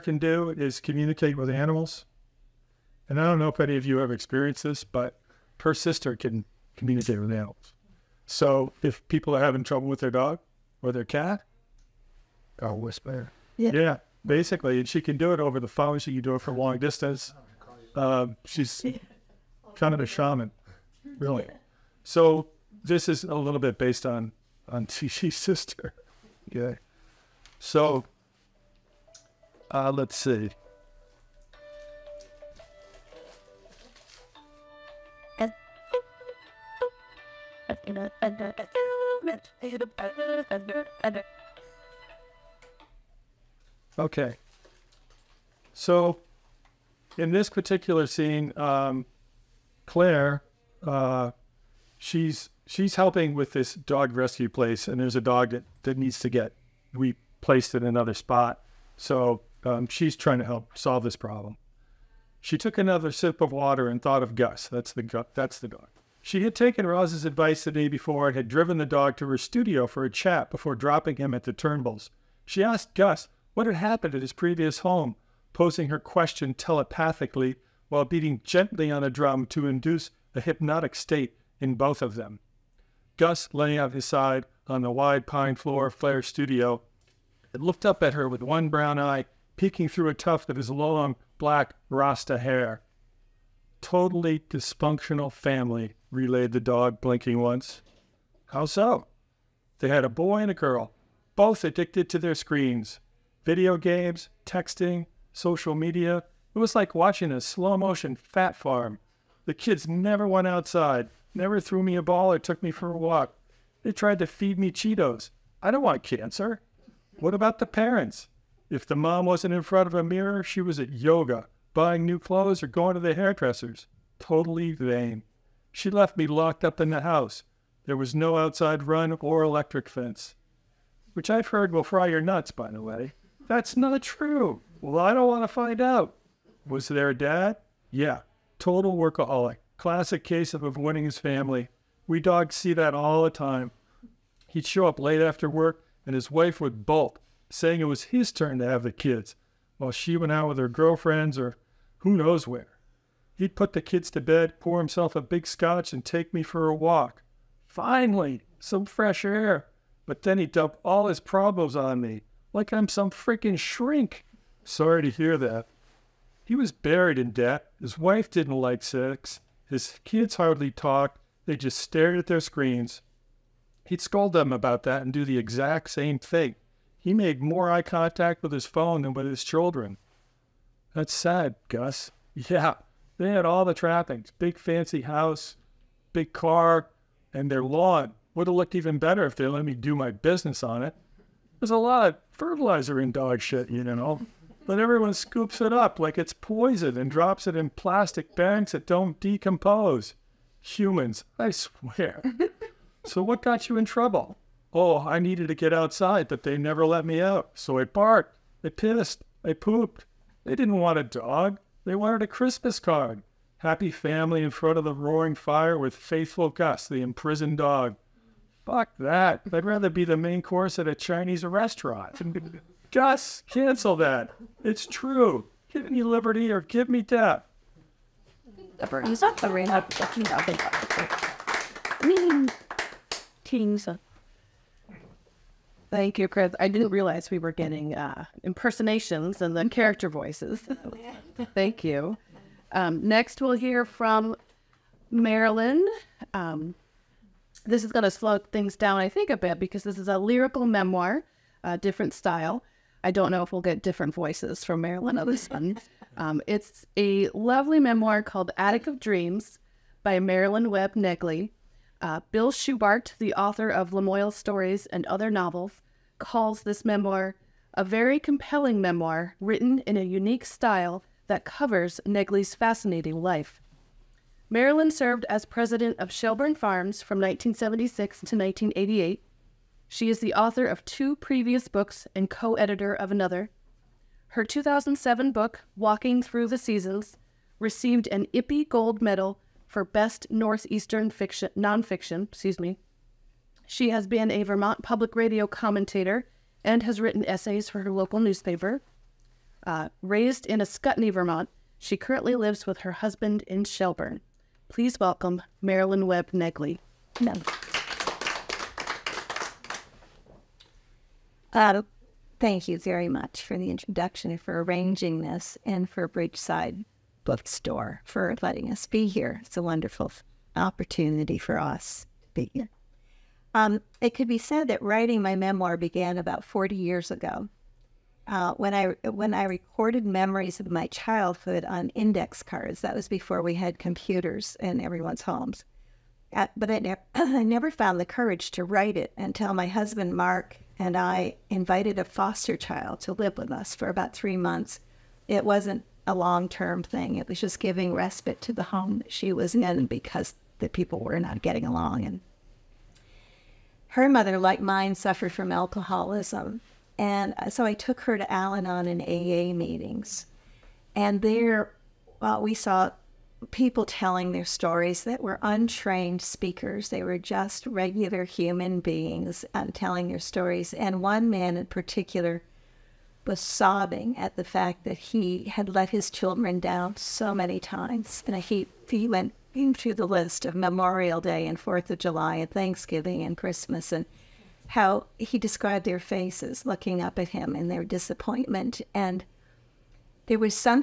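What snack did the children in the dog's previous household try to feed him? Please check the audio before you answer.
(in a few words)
Cheetos.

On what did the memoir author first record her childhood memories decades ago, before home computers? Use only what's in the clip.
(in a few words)
index cards.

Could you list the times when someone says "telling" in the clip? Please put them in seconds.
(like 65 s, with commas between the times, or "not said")
363 s, 369 s.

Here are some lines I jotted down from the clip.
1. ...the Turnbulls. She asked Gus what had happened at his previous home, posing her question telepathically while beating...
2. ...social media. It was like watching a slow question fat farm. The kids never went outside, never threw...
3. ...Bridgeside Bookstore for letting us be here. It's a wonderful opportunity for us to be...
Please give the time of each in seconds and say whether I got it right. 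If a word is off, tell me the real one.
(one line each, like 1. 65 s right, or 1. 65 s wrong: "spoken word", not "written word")
1. 71 s right
2. 105 s wrong: "motion", not "question"
3. 316 s right.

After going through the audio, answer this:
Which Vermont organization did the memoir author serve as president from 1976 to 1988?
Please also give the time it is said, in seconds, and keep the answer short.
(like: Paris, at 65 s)
Shelburne Farms, at 276 s.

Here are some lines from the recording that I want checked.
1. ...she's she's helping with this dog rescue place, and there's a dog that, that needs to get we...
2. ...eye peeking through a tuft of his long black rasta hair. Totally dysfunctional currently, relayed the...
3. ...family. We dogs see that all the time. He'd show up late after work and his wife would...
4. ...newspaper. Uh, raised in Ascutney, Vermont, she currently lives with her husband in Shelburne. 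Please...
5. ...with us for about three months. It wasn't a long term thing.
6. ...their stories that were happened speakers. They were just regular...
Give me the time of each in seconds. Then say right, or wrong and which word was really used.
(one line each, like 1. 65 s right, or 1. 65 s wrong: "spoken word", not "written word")
1. 51 s right
2. 88 s wrong: "family", not "currently"
3. 141 s right
4. 298 s right
5. 343 s right
6. 364 s wrong: "untrained", not "happened".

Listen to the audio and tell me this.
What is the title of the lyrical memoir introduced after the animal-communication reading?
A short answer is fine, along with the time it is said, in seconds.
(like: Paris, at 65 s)
Attic of Dreams, at 258 s.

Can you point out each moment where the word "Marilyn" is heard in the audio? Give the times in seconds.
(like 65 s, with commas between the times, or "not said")
245 s, 254 s, 260 s, 274 s, 305 s.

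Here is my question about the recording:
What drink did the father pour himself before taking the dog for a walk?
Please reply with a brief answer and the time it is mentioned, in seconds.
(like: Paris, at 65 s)
scotch, at 155 s.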